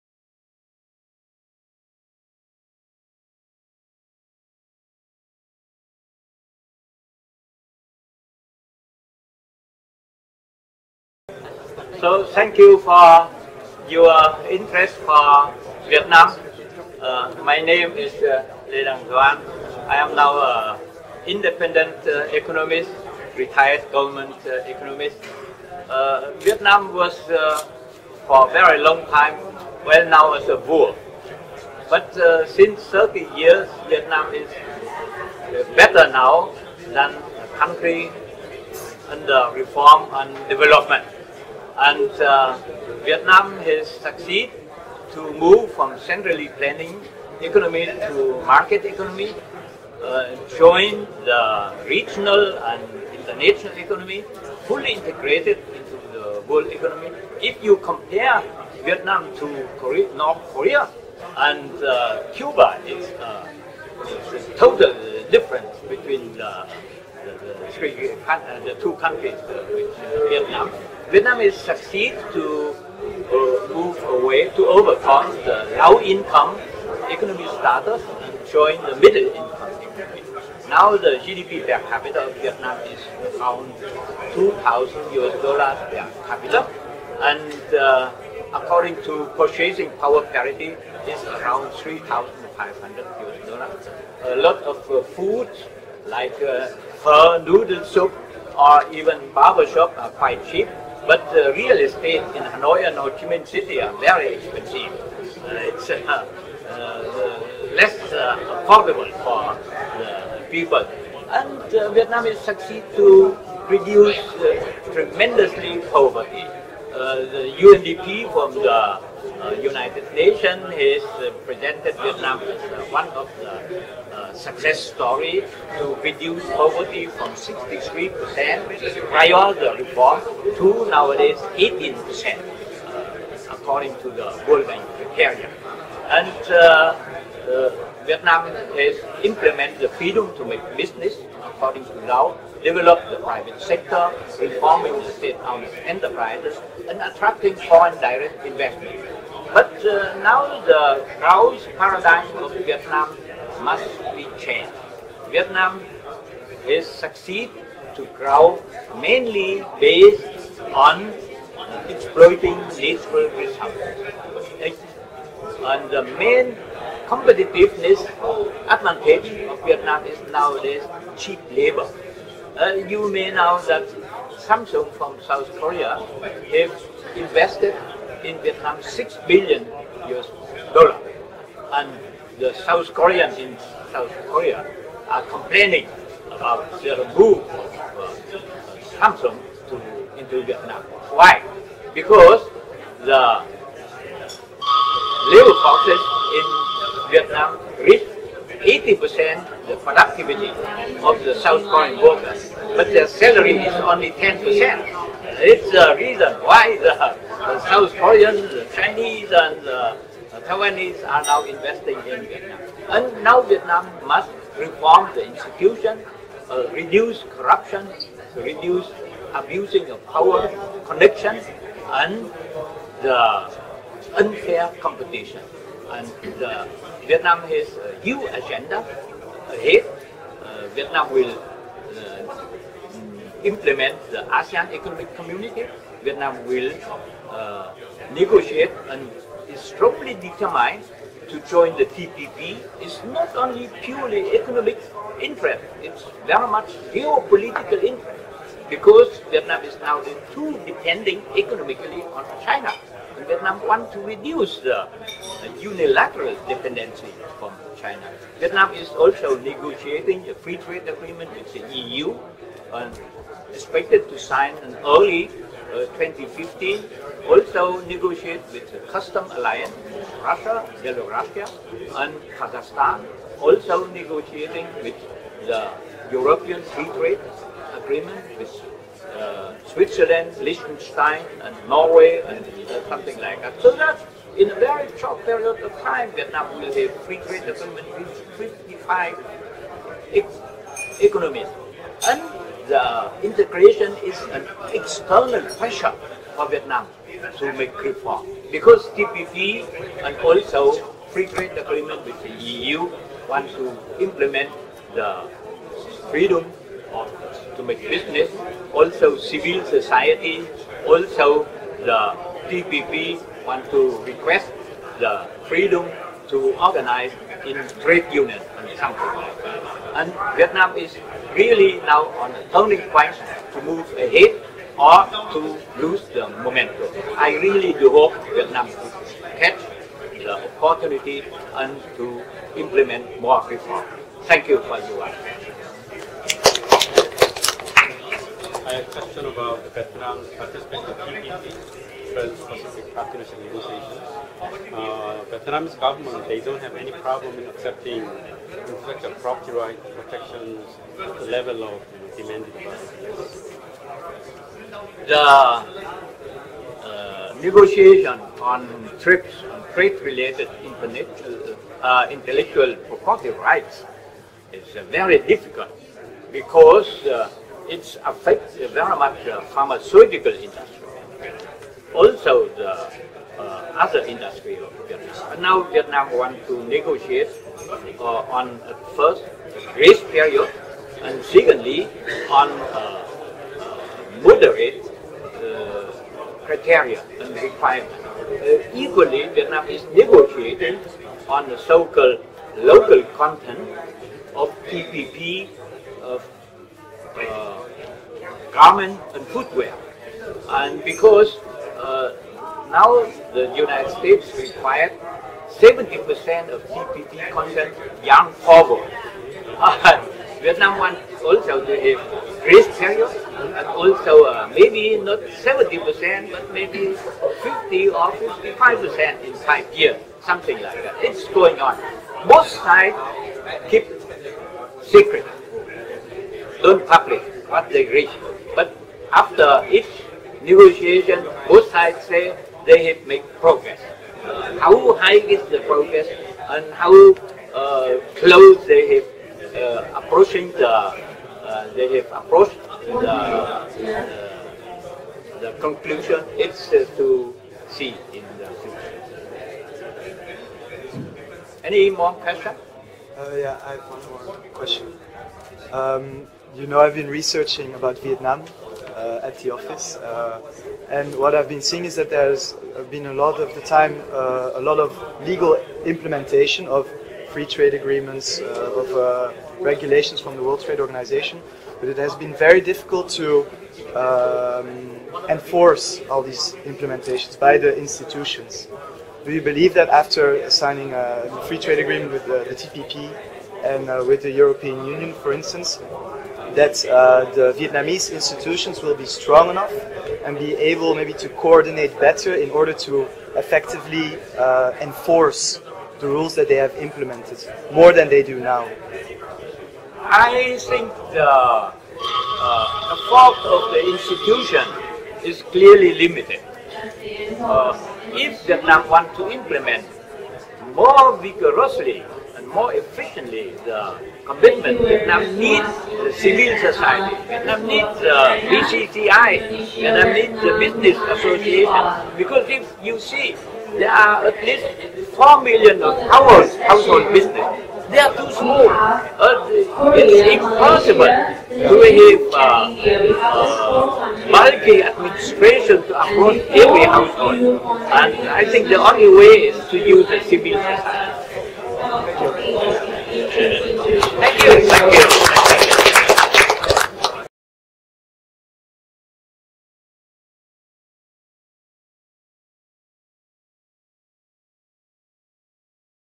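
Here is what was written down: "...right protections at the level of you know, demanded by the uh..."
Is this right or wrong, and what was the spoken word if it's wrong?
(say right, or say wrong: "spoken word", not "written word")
right.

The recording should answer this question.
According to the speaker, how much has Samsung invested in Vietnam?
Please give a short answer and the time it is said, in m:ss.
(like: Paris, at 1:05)
6 billion US dollars, at 2:58.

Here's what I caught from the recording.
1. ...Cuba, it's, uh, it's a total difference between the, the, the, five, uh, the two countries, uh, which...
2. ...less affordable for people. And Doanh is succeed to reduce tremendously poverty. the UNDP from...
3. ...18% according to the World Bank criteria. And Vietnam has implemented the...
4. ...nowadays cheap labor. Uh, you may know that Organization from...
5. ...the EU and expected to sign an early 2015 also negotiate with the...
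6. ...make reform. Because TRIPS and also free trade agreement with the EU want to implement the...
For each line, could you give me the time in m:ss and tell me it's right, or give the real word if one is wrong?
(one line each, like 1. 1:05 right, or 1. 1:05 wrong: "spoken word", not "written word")
1. 1:02 wrong: "three", not "five"
2. 1:47 wrong: "Vietnam", not "Doanh"
3. 2:11 right
4. 2:50 wrong: "Samsung", not "Organization"
5. 4:21 right
6. 4:57 wrong: "TPP", not "TRIPS".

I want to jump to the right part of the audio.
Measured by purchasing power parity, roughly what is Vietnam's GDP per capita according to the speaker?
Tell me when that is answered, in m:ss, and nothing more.
1:31.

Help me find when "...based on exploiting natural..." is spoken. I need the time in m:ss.
2:39.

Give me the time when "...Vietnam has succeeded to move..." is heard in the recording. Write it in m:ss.
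0:43.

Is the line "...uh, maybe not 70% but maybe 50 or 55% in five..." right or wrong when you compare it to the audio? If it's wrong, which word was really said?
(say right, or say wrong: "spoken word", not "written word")
right.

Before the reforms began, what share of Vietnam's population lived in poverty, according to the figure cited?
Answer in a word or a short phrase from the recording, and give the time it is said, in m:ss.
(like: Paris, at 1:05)
63%, at 2:07.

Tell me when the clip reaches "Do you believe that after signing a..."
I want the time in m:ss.
7:59.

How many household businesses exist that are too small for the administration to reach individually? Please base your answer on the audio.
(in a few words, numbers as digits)
4 million.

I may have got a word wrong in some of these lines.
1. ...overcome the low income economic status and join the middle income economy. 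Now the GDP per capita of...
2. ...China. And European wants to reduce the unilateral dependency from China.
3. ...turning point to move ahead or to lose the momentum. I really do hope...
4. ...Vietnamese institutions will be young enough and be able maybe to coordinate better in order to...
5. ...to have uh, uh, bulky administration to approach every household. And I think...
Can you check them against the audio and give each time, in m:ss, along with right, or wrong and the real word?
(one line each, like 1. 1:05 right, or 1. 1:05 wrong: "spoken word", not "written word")
1. 1:14 right
2. 4:12 wrong: "Vietnam", not "European"
3. 5:22 right
4. 8:07 wrong: "strong", not "young"
5. 8:51 right.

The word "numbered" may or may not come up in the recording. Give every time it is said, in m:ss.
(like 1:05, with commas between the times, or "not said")
not said.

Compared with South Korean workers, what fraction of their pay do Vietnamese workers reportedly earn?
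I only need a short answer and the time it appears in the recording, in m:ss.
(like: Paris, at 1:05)
10%, at 3:24.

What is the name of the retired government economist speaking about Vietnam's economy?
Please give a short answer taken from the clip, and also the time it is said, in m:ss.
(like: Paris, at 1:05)
Lê Đăng Doanh, at 0:18.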